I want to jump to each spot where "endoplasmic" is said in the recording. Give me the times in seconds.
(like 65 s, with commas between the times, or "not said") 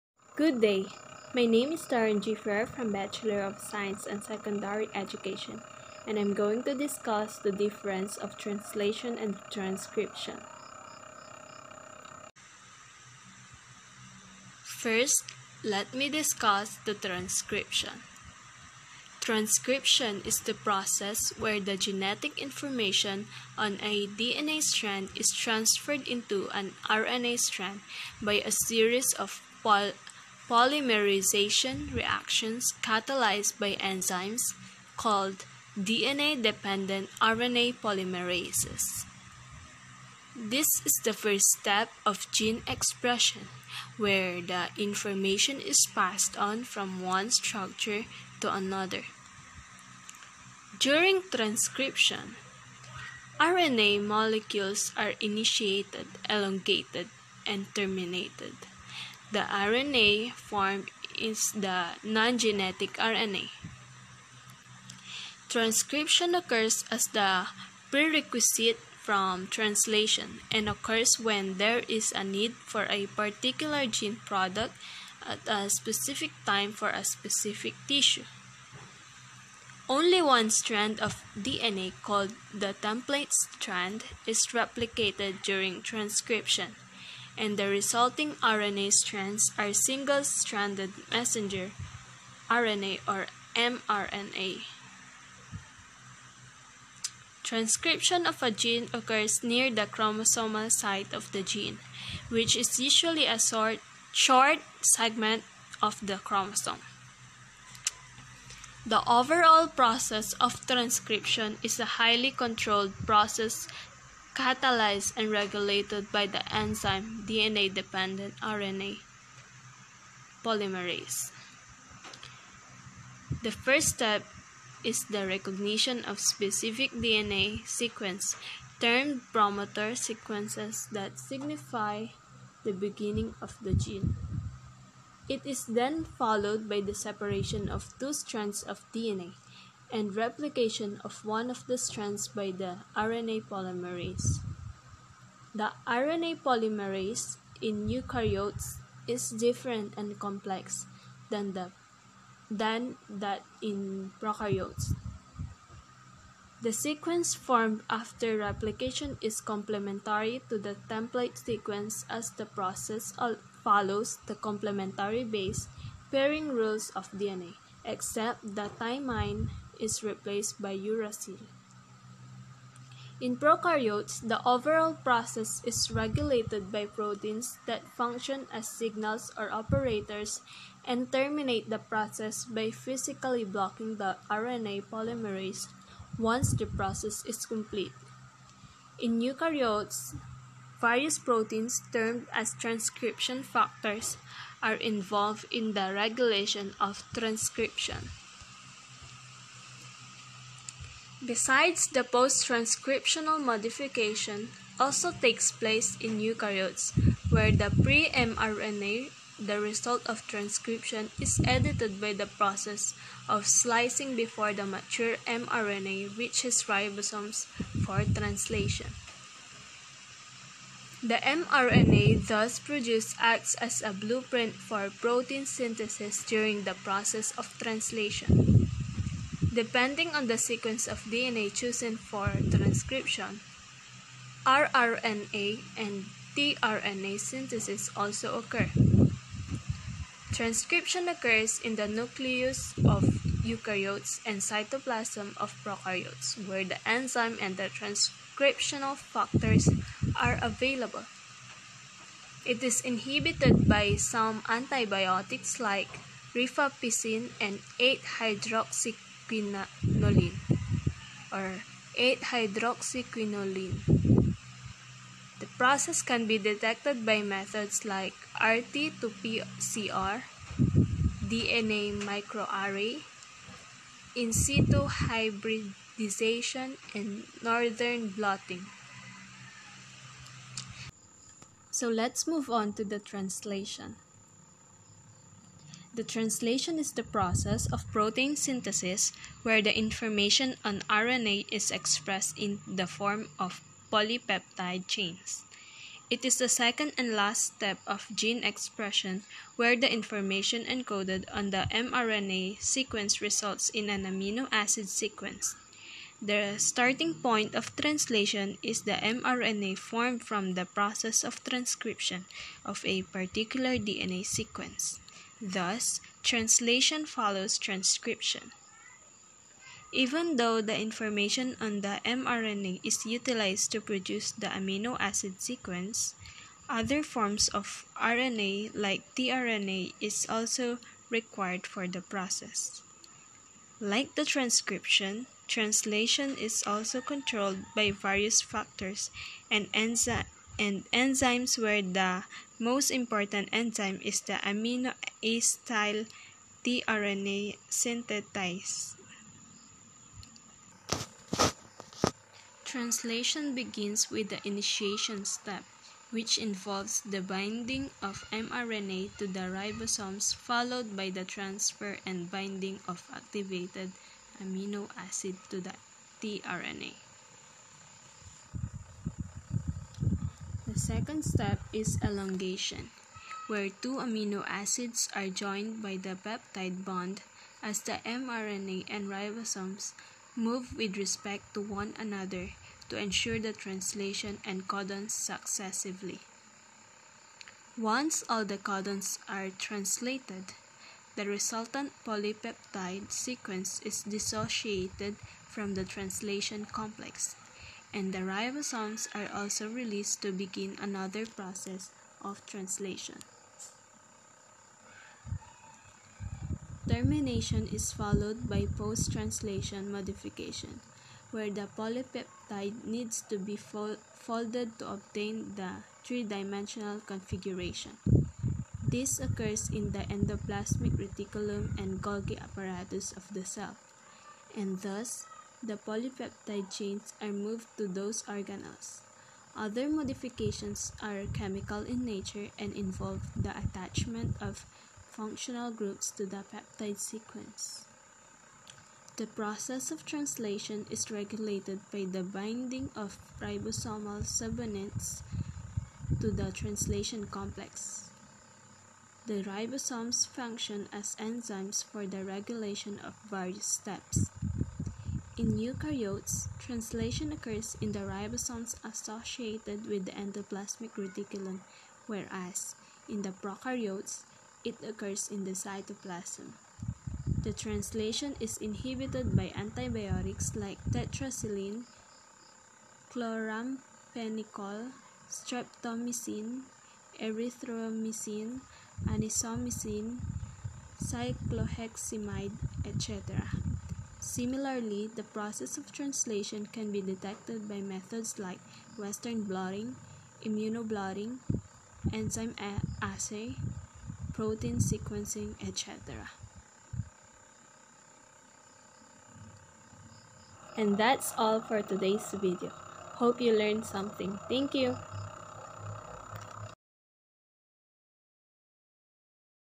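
420 s, 460 s.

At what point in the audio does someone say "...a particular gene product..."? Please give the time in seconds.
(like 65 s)
72 s.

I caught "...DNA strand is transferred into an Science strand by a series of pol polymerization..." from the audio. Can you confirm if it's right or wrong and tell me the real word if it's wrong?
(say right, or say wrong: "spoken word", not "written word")
wrong: "RNA", not "Science".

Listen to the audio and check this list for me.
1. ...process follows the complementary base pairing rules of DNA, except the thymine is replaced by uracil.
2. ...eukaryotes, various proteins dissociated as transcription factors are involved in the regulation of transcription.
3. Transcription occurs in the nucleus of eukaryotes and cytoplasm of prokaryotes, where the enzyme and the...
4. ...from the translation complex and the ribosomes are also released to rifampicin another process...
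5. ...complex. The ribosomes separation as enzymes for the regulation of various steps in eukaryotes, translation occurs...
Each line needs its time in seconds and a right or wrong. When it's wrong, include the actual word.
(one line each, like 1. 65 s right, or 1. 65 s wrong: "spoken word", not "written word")
1. 162 s right
2. 189 s wrong: "termed", not "dissociated"
3. 240 s right
4. 395 s wrong: "begin", not "rifampicin"
5. 447 s wrong: "function", not "separation".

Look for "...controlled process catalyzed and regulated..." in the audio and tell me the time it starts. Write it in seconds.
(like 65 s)
112 s.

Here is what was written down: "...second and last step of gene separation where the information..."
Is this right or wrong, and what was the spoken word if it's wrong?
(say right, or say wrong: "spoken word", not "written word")
wrong: "expression", not "separation".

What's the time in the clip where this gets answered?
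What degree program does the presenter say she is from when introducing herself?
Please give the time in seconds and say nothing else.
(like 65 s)
2 s.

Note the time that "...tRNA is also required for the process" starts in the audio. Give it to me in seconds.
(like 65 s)
329 s.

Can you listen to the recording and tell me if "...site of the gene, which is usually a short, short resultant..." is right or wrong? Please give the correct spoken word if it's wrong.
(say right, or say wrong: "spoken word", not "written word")
wrong: "segment", not "resultant".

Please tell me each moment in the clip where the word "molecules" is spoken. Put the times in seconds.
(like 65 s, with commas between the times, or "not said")
54 s.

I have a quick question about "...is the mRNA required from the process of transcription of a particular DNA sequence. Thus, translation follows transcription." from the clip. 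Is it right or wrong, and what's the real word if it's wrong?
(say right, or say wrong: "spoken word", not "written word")
wrong: "formed", not "required".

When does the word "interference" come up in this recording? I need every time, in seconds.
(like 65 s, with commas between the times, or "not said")
not said.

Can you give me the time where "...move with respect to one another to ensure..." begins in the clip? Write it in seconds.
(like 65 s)
380 s.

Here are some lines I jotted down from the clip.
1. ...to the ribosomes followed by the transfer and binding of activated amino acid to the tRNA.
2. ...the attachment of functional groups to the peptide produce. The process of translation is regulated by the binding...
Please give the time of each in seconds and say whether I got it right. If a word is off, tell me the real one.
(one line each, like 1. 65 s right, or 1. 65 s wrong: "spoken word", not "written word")
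1. 359 s right
2. 433 s wrong: "sequence", not "produce".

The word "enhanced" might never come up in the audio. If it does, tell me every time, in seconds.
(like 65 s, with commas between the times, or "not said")
not said.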